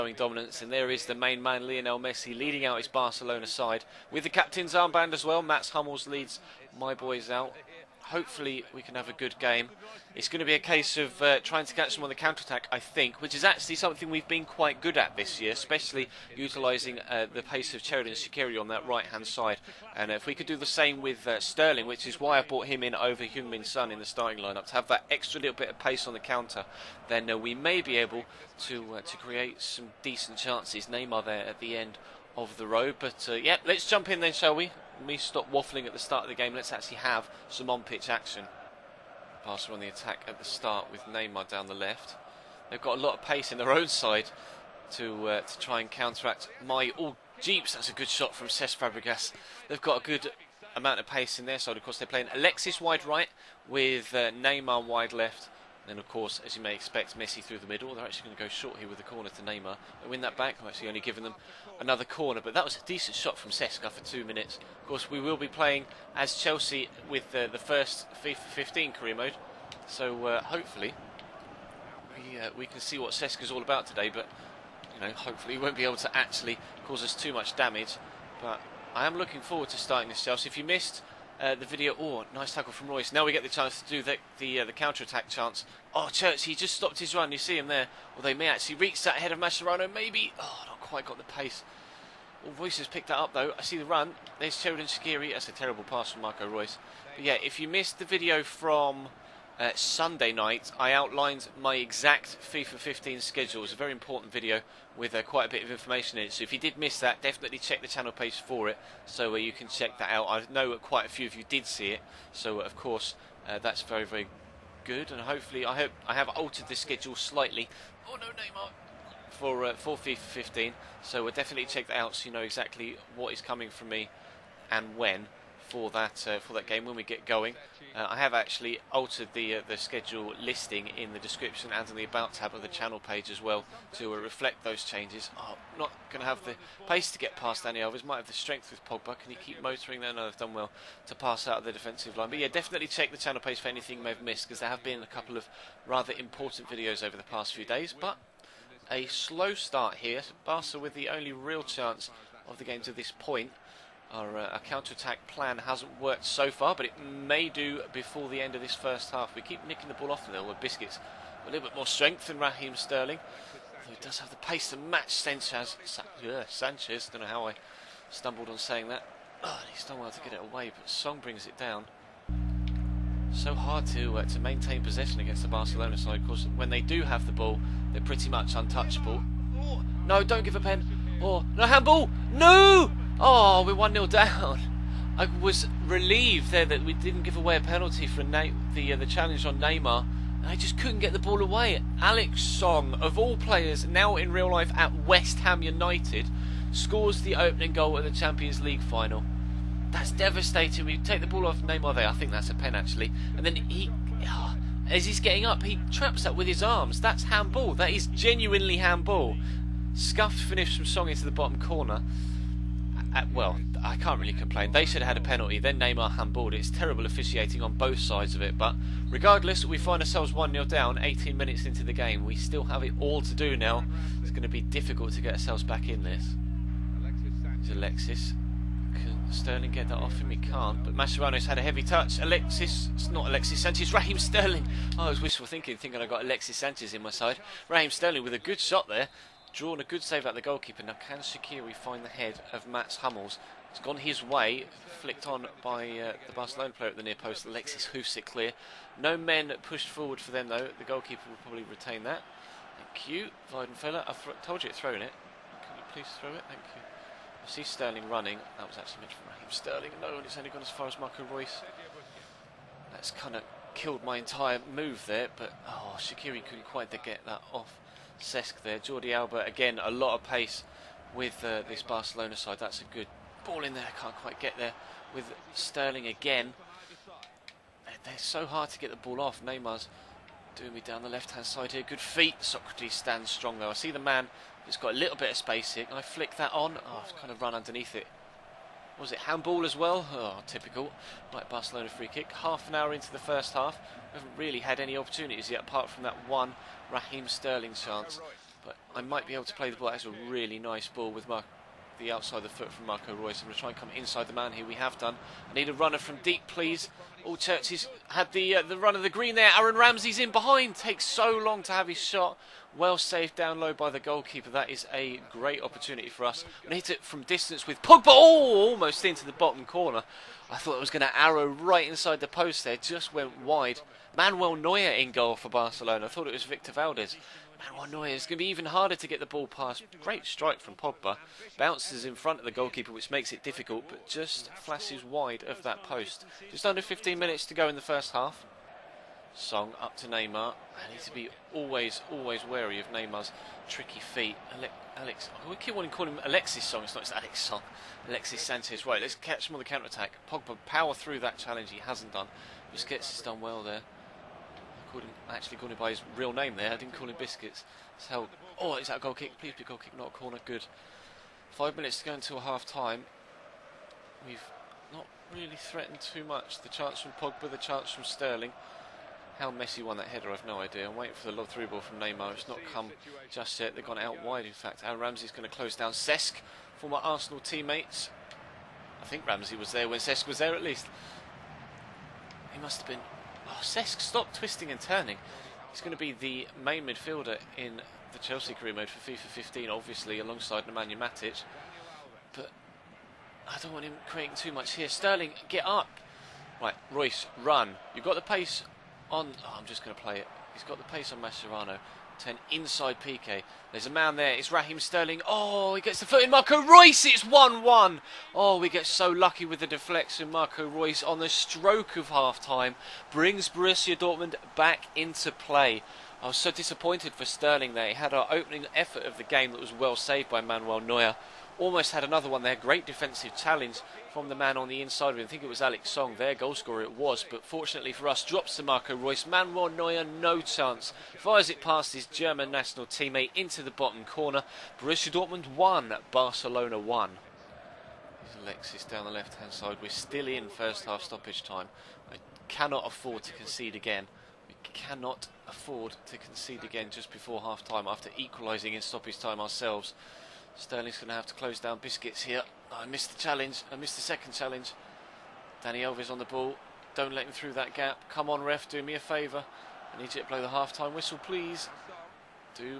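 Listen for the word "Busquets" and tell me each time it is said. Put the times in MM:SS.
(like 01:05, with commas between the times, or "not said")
05:52.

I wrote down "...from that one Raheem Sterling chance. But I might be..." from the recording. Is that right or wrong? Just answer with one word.
right.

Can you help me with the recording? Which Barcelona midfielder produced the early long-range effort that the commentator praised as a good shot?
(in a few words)
Cesc Fabregas.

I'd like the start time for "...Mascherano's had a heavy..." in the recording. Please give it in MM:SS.
03:50.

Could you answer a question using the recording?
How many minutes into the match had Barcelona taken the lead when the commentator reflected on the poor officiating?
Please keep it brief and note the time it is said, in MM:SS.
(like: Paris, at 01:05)
18, at 03:40.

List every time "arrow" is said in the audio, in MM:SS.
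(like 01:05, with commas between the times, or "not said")
05:21.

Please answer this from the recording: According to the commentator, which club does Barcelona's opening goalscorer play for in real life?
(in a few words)
West Ham United.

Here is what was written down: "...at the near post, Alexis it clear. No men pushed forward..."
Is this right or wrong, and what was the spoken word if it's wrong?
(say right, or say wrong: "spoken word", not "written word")
right.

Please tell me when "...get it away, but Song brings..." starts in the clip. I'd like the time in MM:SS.
02:50.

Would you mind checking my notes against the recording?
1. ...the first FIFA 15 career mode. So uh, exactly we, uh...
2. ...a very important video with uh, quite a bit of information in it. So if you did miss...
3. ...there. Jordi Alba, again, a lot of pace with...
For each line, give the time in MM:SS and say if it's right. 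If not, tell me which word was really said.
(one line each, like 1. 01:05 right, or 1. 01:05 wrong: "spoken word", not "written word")
1. 01:07 wrong: "hopefully", not "exactly"
2. 01:43 right
3. 04:28 right.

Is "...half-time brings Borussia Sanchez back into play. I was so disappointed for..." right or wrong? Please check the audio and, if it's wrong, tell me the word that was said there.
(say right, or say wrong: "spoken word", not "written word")
wrong: "Dortmund", not "Sanchez".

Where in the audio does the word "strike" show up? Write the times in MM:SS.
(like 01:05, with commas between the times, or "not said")
05:30.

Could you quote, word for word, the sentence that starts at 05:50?
Pogba power through that challenge he hasn't done.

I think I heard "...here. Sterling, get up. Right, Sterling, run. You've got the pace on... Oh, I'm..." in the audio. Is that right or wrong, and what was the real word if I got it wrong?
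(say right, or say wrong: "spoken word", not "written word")
wrong: "Reus", not "Sterling".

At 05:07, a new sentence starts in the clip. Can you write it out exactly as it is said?
All Churches had the uh, the run of the green there.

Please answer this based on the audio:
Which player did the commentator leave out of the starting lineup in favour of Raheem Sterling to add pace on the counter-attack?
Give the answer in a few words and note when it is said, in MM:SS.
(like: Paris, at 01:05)
Heung-Min Son, at 00:23.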